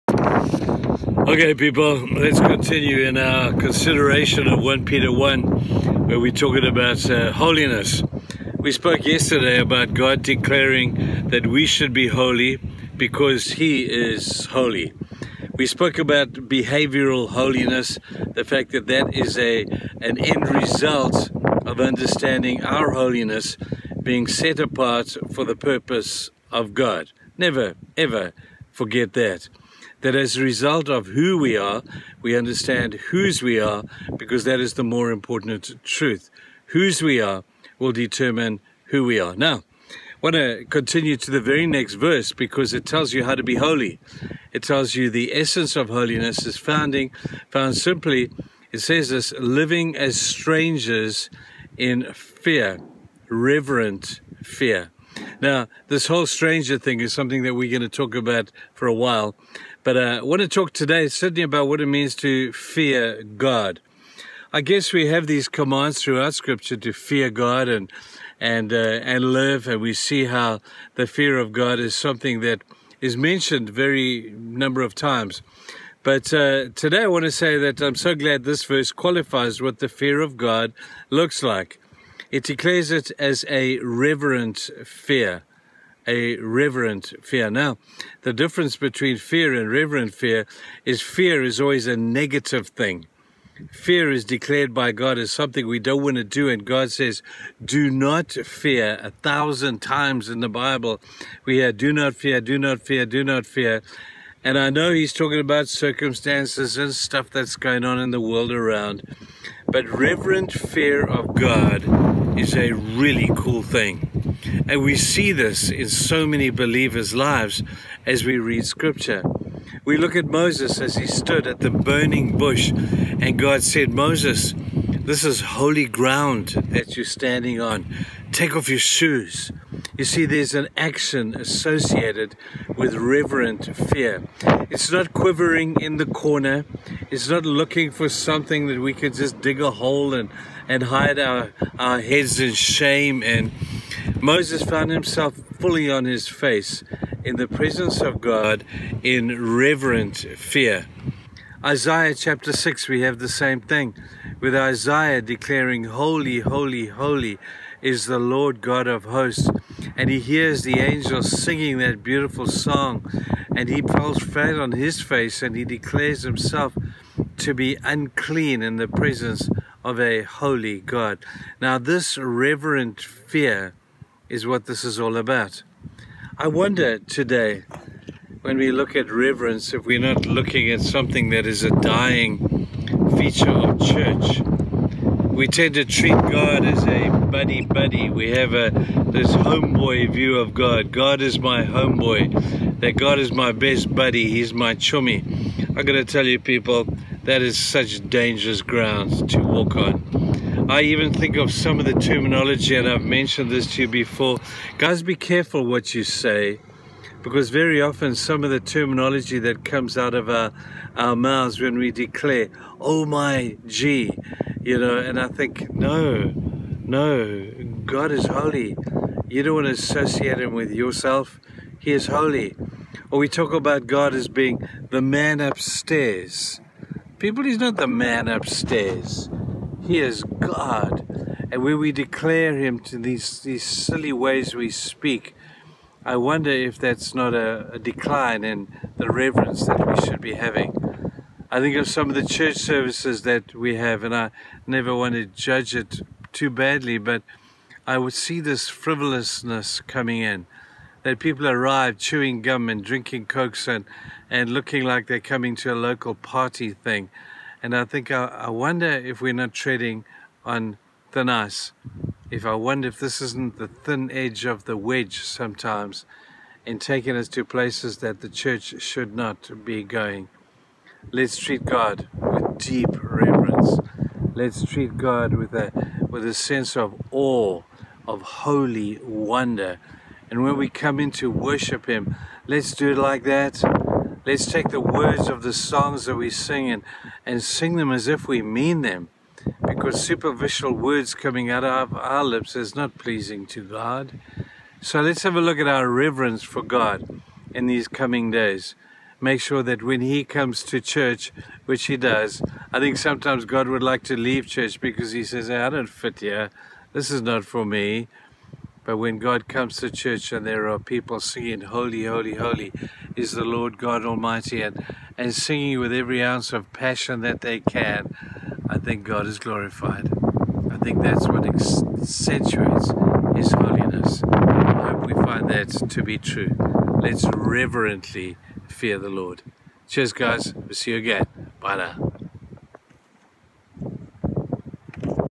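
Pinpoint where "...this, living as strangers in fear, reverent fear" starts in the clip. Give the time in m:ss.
0:49.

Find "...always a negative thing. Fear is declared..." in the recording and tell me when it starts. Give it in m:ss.
1:31.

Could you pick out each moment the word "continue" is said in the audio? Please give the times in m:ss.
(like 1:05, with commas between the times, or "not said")
0:02, 0:40.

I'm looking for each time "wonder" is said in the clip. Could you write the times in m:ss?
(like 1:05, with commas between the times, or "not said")
2:56, 3:56, 4:18, 4:22, 4:39.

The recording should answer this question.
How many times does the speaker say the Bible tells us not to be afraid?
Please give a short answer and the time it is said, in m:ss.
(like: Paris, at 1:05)
A thousand, at 1:39.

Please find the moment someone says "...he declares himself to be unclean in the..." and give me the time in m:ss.
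2:45.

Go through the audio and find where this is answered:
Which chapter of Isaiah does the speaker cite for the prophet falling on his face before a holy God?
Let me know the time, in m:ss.
2:31.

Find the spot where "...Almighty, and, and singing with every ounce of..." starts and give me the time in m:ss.
5:14.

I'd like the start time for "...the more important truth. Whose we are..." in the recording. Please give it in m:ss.
0:34.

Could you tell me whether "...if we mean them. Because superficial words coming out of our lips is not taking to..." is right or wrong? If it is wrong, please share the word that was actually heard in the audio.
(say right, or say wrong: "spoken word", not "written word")
wrong: "pleasing", not "taking".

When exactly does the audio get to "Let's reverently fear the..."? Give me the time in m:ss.
5:27.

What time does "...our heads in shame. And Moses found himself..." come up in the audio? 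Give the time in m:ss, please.
2:21.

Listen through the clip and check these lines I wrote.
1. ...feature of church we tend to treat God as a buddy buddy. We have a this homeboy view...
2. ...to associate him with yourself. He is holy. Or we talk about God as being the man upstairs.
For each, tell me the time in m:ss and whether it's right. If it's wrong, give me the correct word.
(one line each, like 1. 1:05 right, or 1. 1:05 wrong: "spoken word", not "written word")
1. 3:03 right
2. 3:39 right.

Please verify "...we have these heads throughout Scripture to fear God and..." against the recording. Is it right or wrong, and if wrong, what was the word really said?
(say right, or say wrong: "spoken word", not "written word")
wrong: "commands", not "heads".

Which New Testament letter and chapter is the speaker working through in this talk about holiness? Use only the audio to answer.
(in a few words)
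1 Peter 1.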